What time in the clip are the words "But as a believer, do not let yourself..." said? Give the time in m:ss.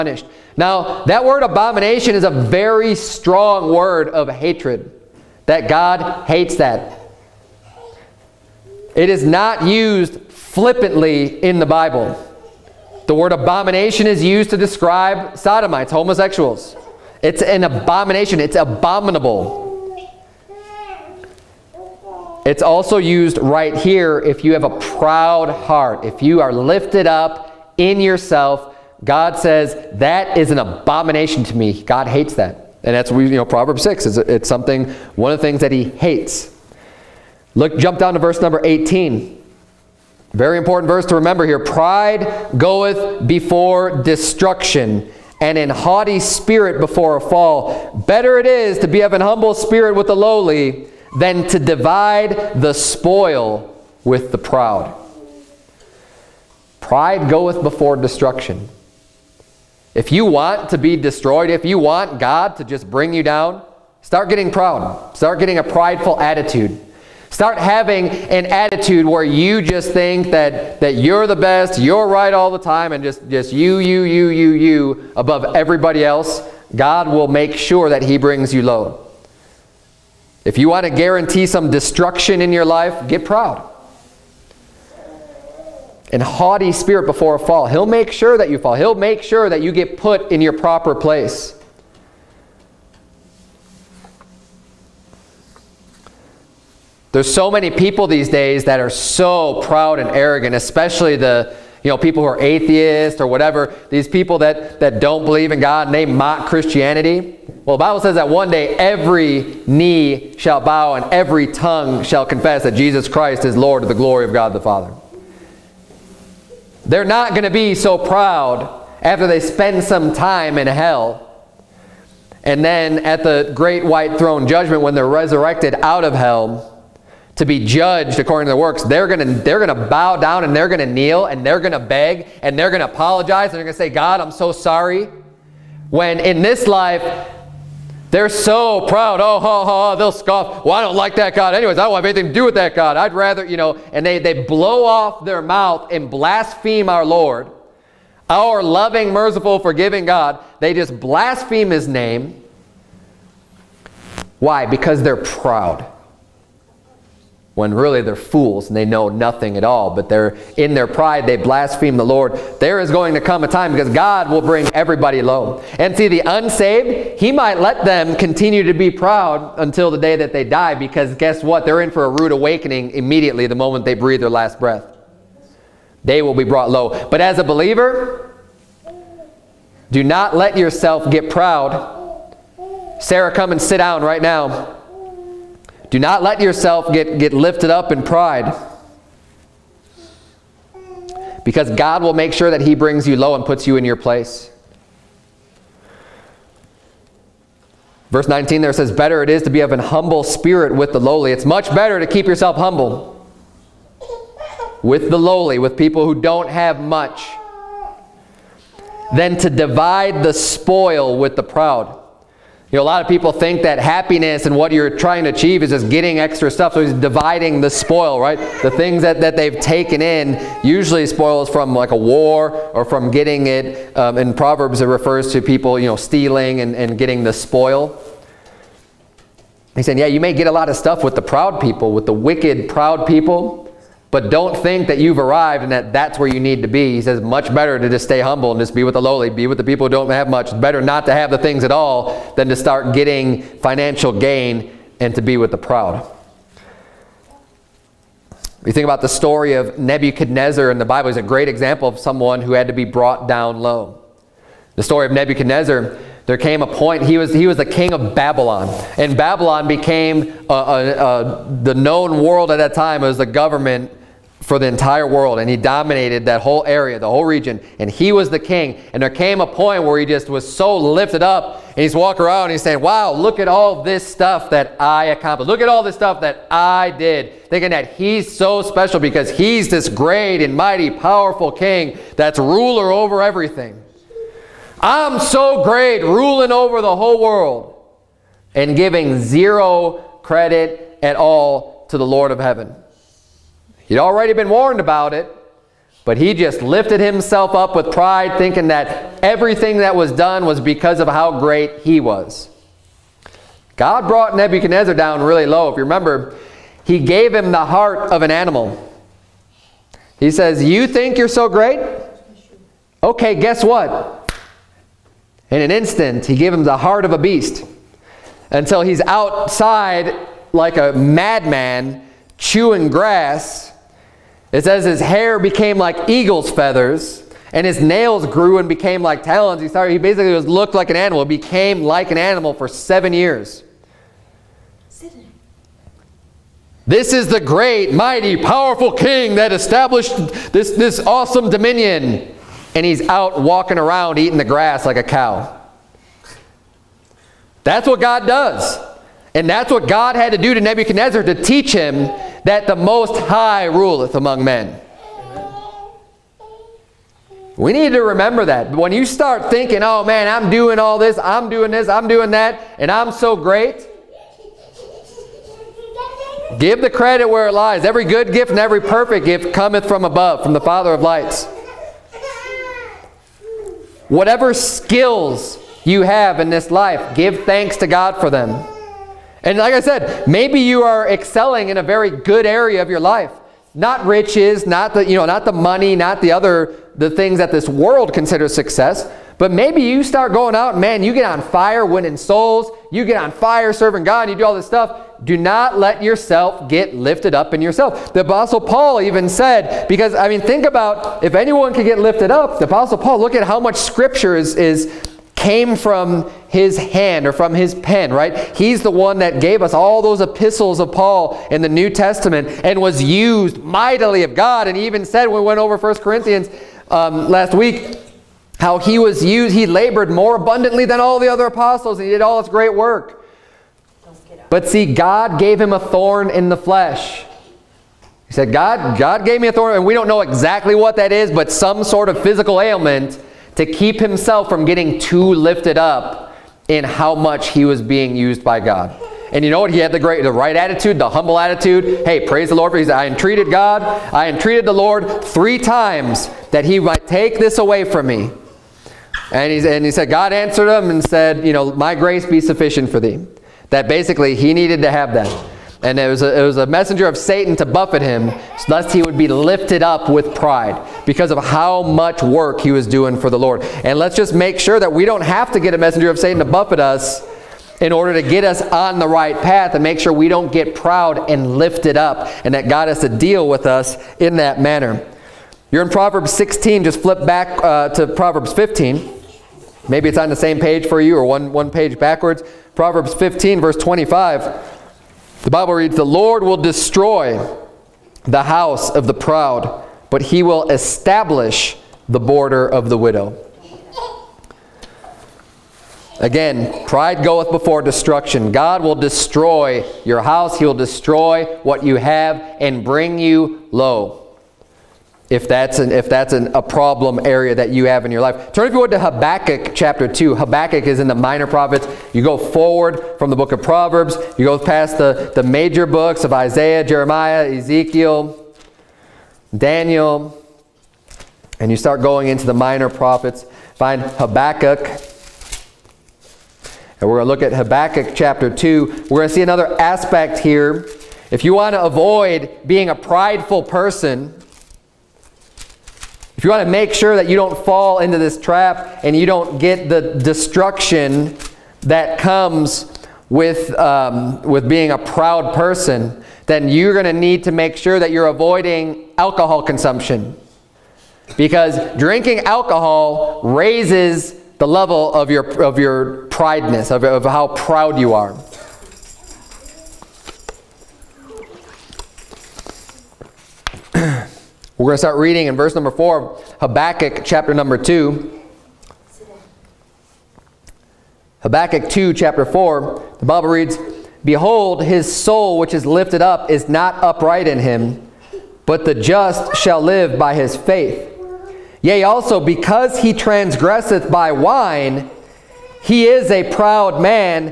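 2:57.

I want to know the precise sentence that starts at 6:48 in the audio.
He's the one that gave us all those epistles of Paul in the New Testament and was used mightily of God.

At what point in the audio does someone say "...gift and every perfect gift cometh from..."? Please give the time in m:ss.
6:08.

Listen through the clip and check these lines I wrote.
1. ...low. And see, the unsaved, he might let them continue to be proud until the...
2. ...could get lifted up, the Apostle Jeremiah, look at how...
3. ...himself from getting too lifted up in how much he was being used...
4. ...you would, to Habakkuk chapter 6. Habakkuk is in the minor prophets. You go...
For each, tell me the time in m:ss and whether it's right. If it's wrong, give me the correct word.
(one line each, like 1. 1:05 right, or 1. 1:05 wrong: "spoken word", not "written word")
1. 2:45 right
2. 6:41 wrong: "Paul", not "Jeremiah"
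3. 7:13 right
4. 8:28 wrong: "2", not "6".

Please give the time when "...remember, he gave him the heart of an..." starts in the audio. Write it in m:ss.
5:05.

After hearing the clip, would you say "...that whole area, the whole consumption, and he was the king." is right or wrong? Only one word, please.
wrong.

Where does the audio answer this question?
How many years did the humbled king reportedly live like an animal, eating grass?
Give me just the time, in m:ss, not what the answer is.
5:32.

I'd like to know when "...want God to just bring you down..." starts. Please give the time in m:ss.
1:01.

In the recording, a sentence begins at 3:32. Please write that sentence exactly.
You know, a lot of people think that happiness and what you're trying to achieve is just getting extra stuff.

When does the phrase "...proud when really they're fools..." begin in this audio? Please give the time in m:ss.
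2:35.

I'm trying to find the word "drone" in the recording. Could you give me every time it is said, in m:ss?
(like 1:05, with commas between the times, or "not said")
not said.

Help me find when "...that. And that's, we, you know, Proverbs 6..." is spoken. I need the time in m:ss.
0:32.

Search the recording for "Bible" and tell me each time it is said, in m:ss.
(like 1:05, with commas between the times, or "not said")
0:11, 1:47, 4:10, 8:05, 9:33.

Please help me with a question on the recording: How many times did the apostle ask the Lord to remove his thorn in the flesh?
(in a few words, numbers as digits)
3.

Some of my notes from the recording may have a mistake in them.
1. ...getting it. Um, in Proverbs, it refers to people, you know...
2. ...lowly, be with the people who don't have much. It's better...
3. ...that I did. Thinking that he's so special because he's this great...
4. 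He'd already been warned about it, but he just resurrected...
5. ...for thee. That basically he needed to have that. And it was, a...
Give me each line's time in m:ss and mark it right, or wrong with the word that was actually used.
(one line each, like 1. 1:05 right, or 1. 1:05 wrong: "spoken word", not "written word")
1. 3:43 right
2. 3:59 right
3. 4:36 right
4. 4:53 wrong: "lifted", not "resurrected"
5. 7:32 right.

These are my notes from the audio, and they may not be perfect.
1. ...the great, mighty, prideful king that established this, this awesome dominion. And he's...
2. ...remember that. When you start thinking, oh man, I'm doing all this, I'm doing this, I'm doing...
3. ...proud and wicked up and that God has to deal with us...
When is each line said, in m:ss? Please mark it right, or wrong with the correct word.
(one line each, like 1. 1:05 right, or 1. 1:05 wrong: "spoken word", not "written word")
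1. 5:37 wrong: "powerful", not "prideful"
2. 5:58 right
3. 7:50 wrong: "lifted", not "wicked".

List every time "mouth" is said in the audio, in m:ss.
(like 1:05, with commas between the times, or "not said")
2:25.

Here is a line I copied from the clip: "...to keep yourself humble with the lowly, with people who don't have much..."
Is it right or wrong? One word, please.
right.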